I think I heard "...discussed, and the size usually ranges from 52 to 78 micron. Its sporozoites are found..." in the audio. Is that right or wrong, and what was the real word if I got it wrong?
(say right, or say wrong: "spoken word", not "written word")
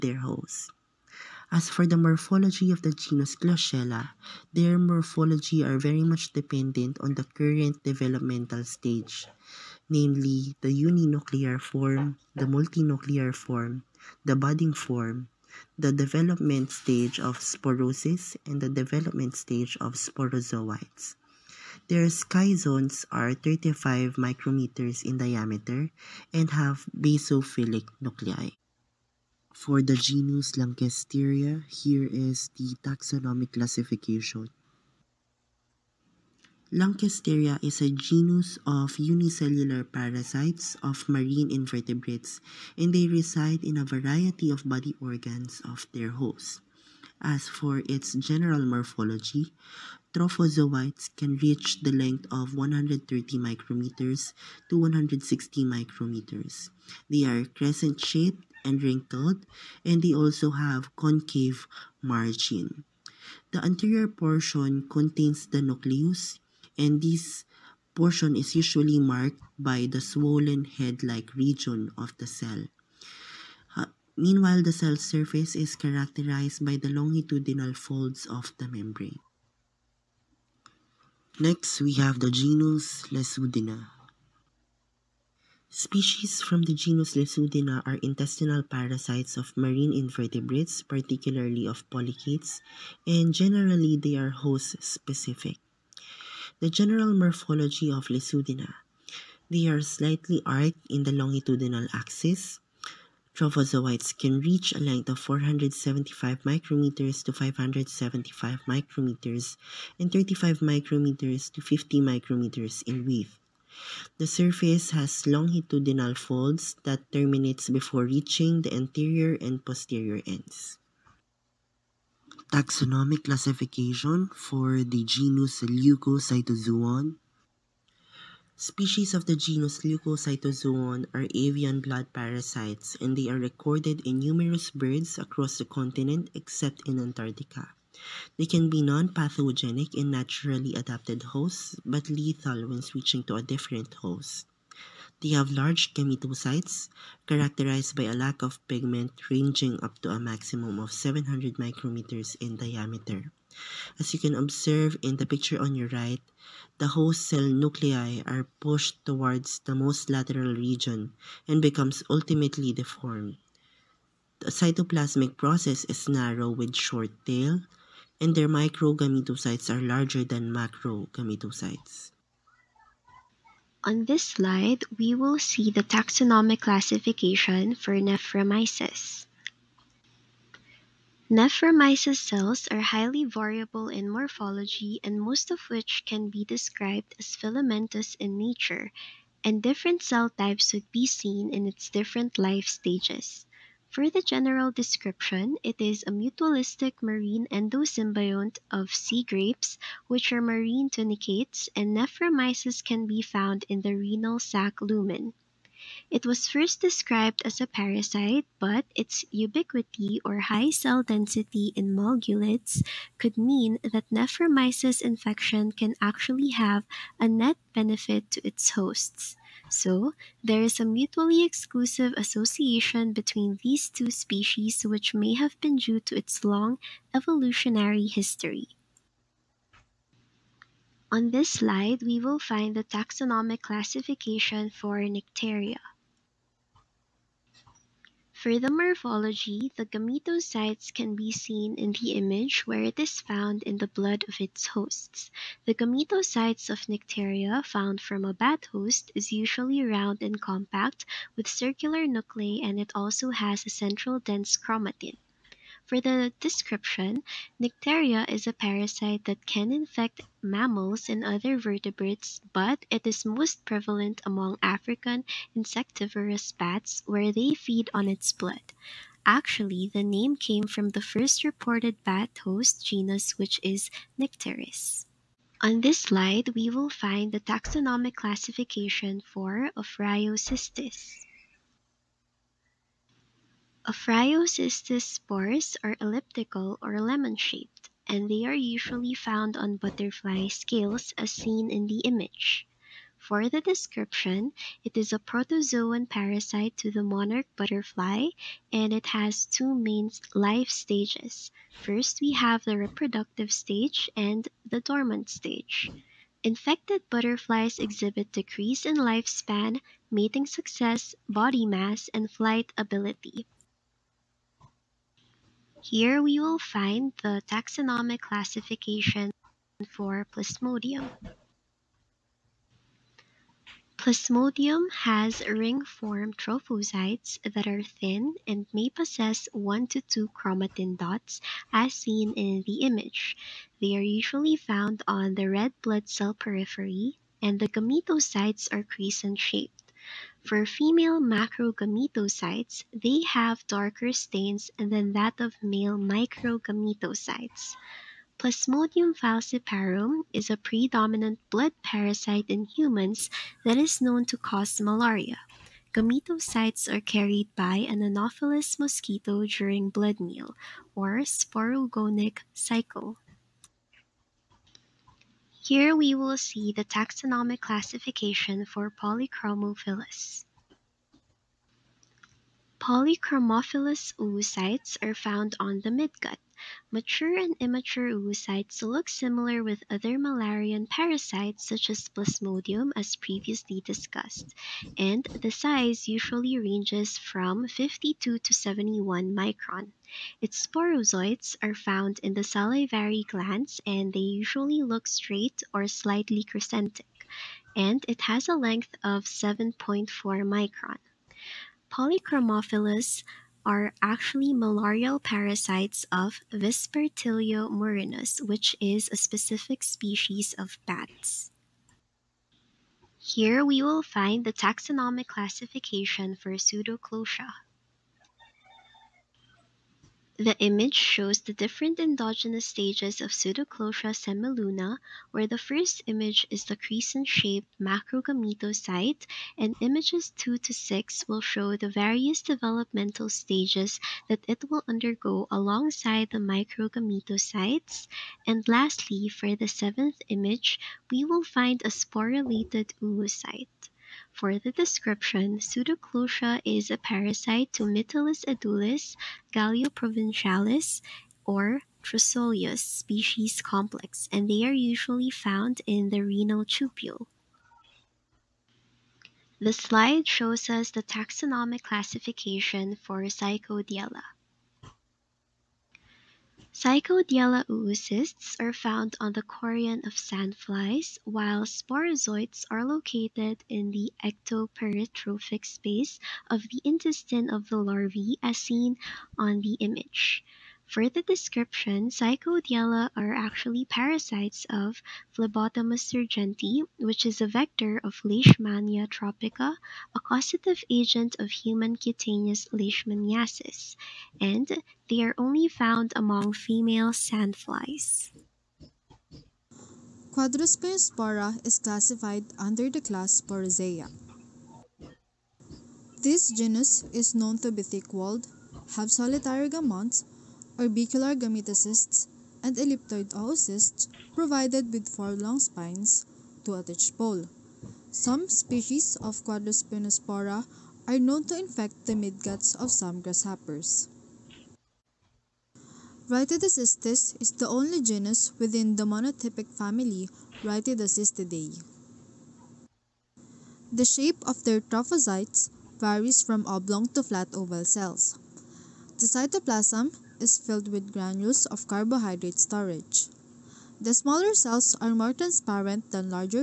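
wrong: "71", not "78".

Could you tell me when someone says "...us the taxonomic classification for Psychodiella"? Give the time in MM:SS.
07:40.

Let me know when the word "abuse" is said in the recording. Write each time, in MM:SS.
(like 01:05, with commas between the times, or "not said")
not said.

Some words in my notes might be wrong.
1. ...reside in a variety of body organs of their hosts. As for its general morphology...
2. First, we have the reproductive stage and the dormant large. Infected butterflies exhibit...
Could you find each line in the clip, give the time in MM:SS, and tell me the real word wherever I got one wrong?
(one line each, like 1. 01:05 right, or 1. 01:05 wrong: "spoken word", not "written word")
1. 00:43 right
2. 05:01 wrong: "stage", not "large".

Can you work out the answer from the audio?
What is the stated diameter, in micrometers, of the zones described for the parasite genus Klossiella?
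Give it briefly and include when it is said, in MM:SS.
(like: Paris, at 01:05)
35 micrometers, at 00:23.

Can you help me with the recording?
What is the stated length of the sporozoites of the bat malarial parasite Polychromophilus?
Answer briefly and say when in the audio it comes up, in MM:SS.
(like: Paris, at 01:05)
7.4 micron, at 06:39.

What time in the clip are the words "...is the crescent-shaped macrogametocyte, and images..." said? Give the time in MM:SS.
07:06.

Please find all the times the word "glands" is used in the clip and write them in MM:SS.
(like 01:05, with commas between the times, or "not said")
06:33.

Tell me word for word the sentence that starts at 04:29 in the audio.
Actually, the name came from the first reported bat host genus, which is Nycteris.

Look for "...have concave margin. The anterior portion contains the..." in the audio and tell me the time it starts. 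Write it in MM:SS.
01:00.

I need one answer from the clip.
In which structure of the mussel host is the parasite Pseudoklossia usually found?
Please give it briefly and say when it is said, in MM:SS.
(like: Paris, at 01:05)
renal tubule, at 07:36.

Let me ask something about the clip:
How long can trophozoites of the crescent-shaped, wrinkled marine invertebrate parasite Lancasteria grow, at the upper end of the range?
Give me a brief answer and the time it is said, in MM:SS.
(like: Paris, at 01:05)
160 micrometers, at 00:54.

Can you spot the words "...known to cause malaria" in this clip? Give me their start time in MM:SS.
05:54.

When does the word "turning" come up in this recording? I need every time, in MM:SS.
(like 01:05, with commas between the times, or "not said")
not said.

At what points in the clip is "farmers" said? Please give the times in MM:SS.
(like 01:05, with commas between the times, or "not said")
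not said.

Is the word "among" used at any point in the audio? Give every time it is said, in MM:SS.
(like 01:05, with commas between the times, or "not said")
04:24, 08:16.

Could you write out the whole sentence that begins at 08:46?
Rhytidocystis is the only genus within the monotypic family Rhytidocystidae.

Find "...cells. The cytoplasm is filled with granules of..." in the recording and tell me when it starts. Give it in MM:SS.
08:57.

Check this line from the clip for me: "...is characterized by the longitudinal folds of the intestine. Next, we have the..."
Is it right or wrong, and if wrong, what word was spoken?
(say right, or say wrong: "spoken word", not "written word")
wrong: "membrane", not "intestine".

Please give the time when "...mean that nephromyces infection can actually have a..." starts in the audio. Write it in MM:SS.
03:33.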